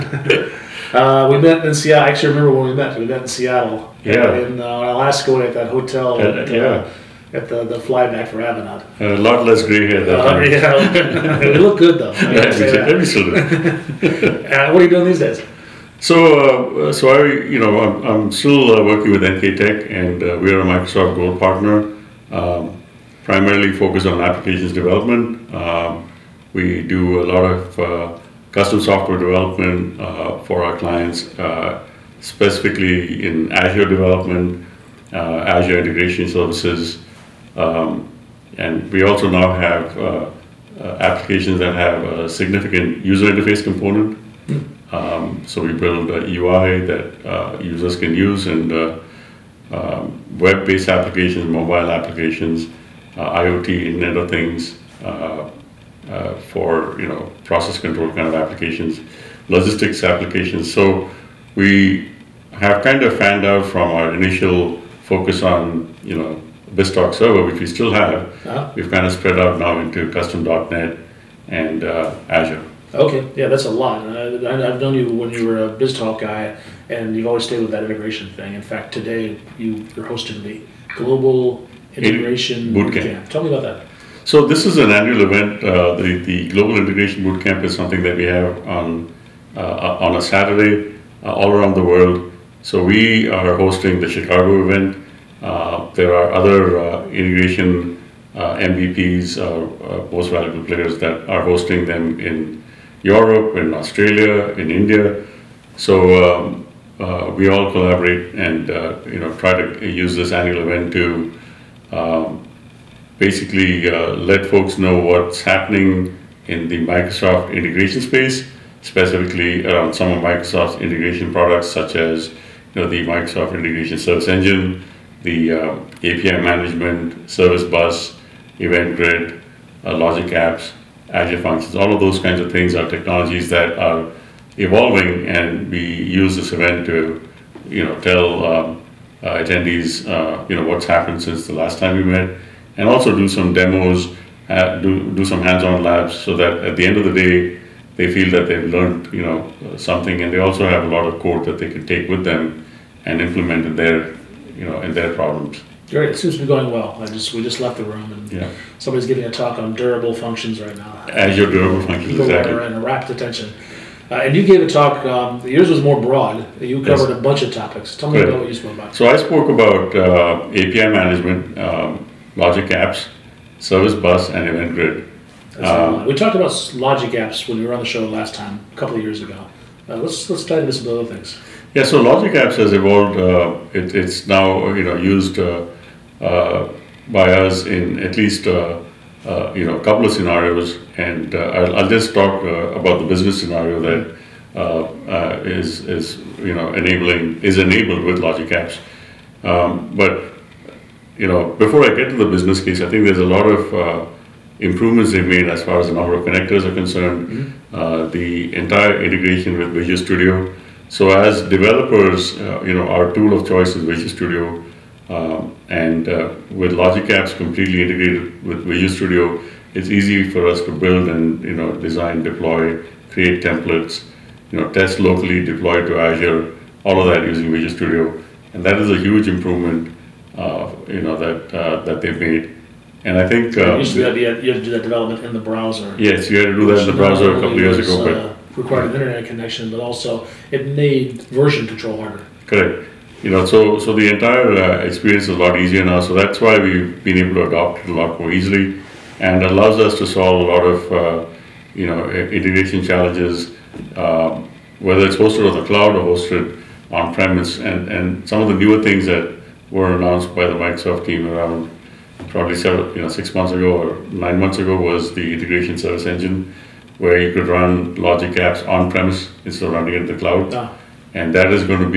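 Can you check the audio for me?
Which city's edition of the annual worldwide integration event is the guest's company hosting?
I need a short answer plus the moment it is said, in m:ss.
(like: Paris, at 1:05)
Chicago, at 1:34.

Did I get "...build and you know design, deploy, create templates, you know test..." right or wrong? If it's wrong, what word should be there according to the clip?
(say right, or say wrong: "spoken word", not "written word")
right.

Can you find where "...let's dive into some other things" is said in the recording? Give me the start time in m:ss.
3:00.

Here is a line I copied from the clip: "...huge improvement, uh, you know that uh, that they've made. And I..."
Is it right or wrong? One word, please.
right.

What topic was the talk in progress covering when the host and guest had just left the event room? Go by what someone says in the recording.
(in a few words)
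Azure durable functions.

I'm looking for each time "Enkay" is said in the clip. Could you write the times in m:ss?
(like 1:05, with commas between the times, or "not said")
0:19.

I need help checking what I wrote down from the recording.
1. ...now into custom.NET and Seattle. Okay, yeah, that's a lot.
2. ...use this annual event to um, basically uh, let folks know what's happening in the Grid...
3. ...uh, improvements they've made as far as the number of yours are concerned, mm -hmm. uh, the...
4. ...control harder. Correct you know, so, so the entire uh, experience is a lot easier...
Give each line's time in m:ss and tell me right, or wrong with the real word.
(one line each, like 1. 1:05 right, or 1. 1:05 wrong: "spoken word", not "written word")
1. 1:09 wrong: "Azure", not "Seattle"
2. 1:49 wrong: "Microsoft", not "Grid"
3. 3:23 wrong: "connectors", not "yours"
4. 4:01 right.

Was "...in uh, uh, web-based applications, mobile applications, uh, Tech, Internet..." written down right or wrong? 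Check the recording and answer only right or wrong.
wrong.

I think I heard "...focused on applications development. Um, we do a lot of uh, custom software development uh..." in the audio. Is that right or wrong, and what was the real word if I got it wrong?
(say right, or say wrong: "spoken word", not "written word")
right.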